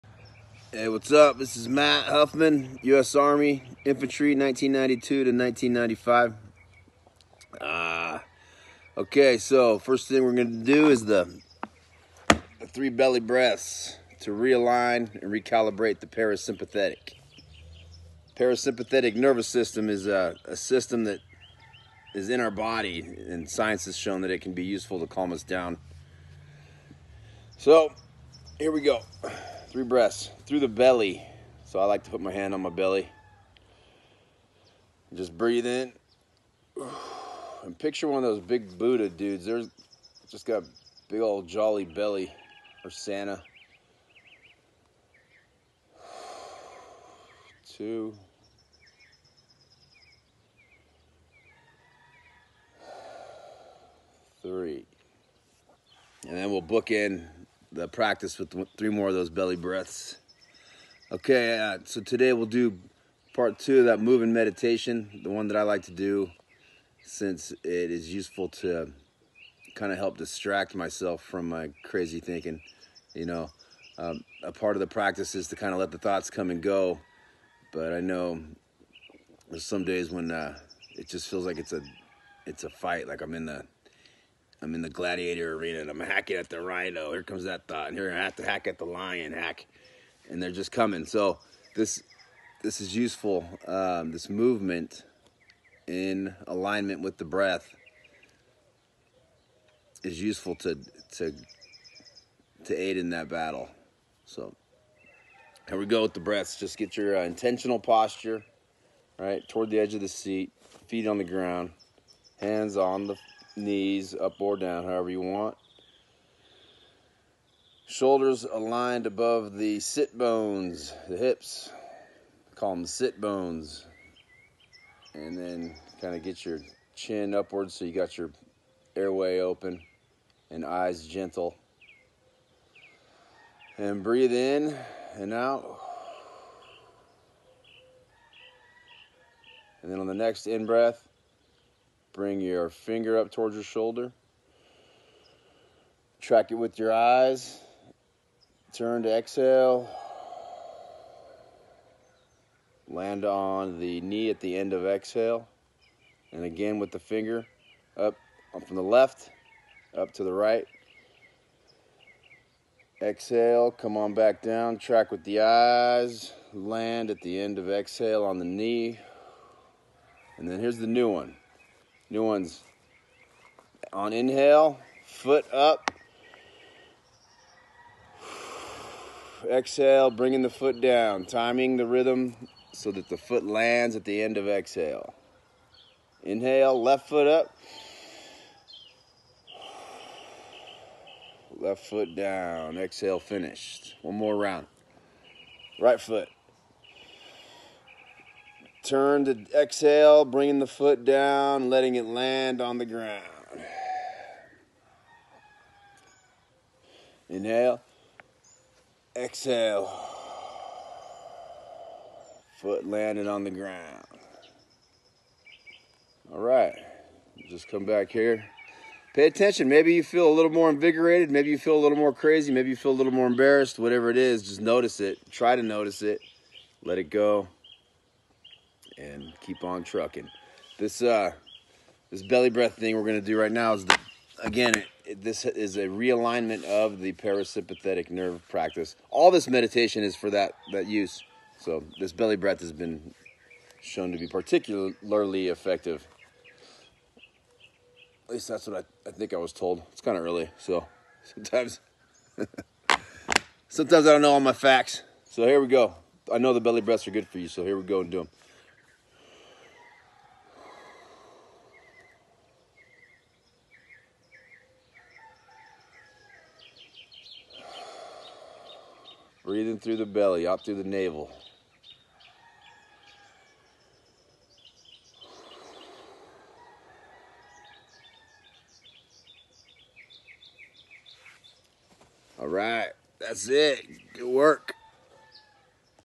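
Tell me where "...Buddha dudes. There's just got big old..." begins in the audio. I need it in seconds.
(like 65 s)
38 s.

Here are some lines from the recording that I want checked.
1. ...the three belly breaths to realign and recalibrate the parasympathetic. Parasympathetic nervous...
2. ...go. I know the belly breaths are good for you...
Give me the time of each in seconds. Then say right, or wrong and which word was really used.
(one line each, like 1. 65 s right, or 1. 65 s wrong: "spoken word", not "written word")
1. 11 s right
2. 255 s right.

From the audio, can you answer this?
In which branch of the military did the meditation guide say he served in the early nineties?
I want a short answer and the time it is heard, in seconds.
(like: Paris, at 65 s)
U.S. Army, at 2 s.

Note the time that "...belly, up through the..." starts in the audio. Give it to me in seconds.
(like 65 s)
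270 s.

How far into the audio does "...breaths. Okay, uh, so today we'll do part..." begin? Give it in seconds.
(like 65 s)
59 s.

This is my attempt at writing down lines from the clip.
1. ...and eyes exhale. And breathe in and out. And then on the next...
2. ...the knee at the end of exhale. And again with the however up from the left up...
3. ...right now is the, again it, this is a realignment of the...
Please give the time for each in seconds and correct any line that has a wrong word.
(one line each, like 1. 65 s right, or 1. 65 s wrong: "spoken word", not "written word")
1. 130 s wrong: "gentle", not "exhale"
2. 153 s wrong: "finger", not "however"
3. 233 s right.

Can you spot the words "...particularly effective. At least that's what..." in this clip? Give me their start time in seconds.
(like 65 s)
244 s.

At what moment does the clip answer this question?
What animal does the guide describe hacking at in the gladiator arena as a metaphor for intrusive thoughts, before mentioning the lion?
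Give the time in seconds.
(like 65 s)
86 s.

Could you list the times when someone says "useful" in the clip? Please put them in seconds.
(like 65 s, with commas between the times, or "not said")
24 s, 68 s, 92 s, 100 s.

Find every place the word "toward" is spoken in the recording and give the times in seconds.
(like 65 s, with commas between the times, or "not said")
109 s, 143 s.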